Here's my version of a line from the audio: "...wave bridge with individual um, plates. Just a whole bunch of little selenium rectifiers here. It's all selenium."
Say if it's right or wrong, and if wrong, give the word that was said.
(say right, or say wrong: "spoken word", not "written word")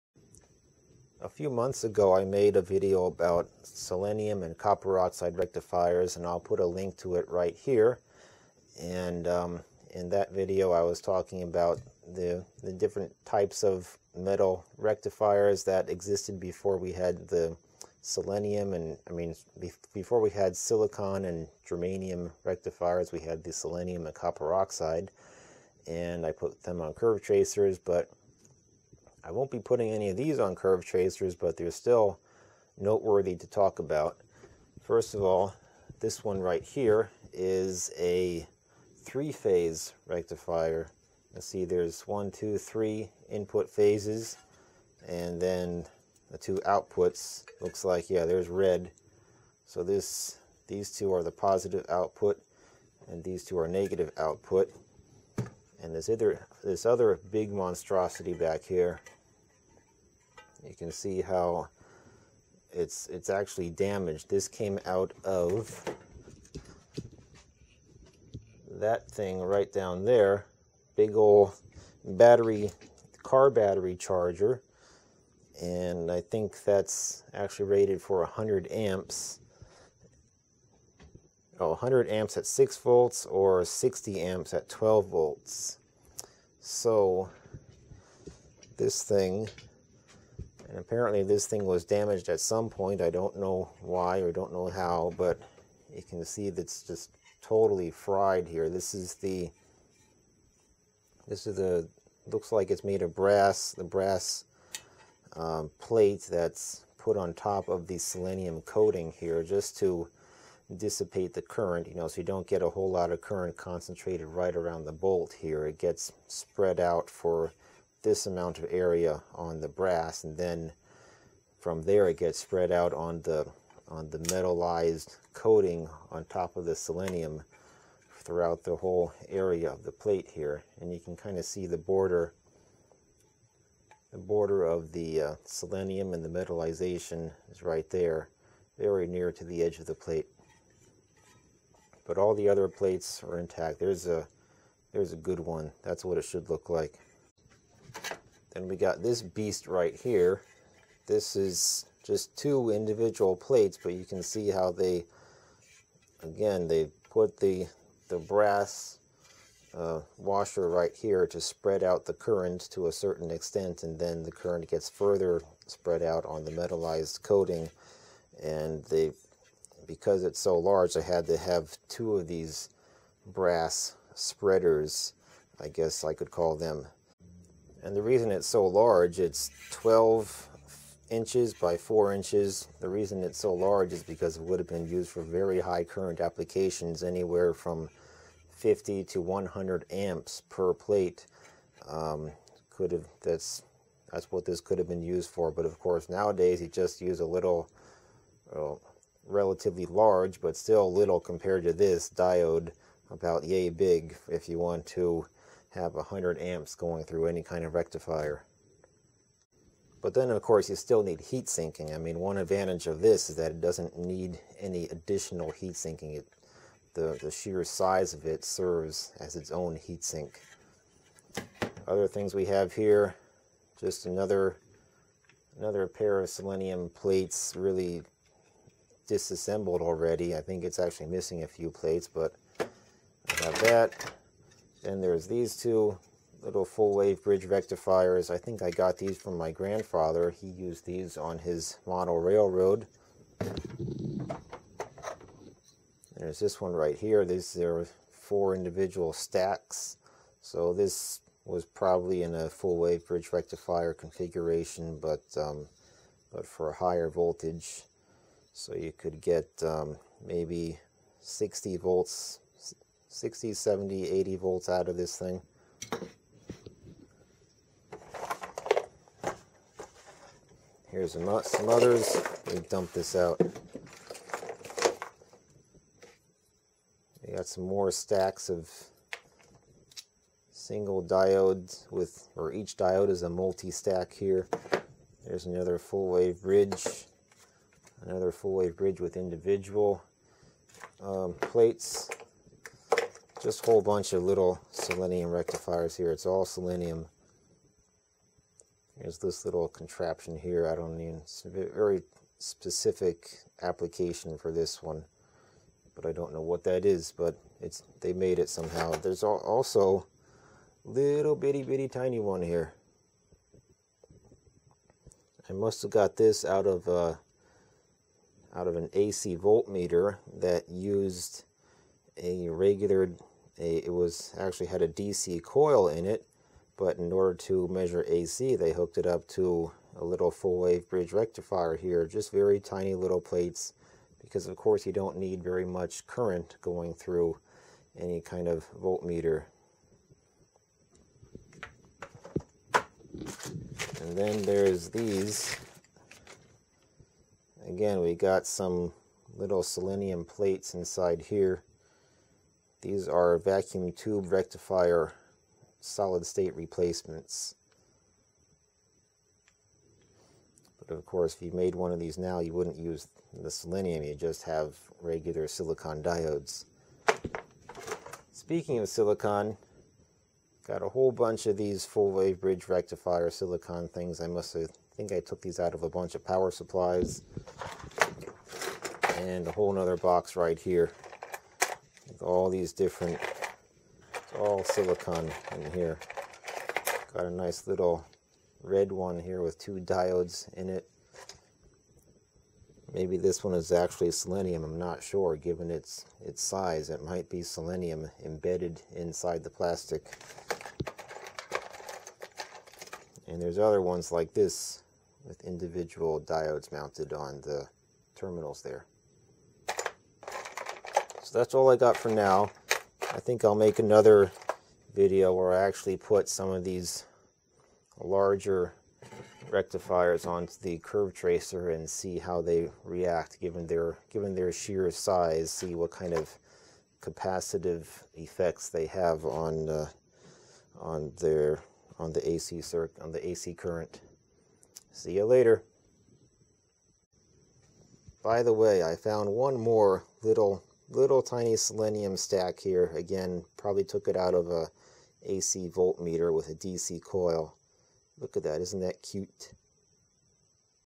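right.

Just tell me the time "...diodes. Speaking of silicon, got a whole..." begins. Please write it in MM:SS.
06:06.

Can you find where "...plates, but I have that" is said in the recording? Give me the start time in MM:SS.
03:51.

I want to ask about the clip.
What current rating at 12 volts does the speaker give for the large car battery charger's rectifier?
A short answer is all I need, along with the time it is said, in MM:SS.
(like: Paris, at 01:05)
60 amps, at 01:23.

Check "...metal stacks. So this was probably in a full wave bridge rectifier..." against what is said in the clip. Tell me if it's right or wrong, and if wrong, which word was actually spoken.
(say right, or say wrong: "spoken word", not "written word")
wrong: "individual", not "metal".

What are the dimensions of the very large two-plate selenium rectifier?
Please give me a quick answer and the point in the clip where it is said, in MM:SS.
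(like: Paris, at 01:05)
12 by 4 inches, at 02:59.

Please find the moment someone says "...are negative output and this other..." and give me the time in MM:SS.
00:53.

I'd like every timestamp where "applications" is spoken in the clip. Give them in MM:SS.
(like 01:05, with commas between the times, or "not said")
03:06, 05:03.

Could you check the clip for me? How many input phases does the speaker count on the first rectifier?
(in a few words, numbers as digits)
3.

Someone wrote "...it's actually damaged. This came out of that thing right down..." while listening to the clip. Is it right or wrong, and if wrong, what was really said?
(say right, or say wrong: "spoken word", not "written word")
right.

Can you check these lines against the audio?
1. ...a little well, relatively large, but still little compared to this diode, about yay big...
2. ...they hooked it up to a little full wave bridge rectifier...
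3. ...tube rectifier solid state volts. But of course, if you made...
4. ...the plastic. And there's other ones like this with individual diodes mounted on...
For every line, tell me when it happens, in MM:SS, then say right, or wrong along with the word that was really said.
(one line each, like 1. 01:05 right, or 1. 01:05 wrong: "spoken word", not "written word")
1. 03:17 right
2. 05:28 right
3. 05:53 wrong: "replacements", not "volts"
4. 06:39 right.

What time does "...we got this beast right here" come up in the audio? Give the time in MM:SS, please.
02:28.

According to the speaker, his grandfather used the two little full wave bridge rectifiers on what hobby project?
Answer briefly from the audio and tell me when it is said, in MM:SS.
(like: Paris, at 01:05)
Model railroad, at 04:01.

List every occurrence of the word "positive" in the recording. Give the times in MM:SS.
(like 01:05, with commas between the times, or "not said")
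00:51.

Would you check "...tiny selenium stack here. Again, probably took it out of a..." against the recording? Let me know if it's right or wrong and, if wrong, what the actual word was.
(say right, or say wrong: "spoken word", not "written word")
right.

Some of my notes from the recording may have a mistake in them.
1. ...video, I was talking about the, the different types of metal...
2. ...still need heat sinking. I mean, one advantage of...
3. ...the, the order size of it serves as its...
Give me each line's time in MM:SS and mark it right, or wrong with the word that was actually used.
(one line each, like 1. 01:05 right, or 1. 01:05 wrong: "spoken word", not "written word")
1. 00:10 right
2. 03:30 right
3. 03:36 wrong: "sheer", not "order".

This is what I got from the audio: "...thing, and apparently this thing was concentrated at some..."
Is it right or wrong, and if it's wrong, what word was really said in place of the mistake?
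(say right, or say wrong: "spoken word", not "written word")
wrong: "damaged", not "concentrated".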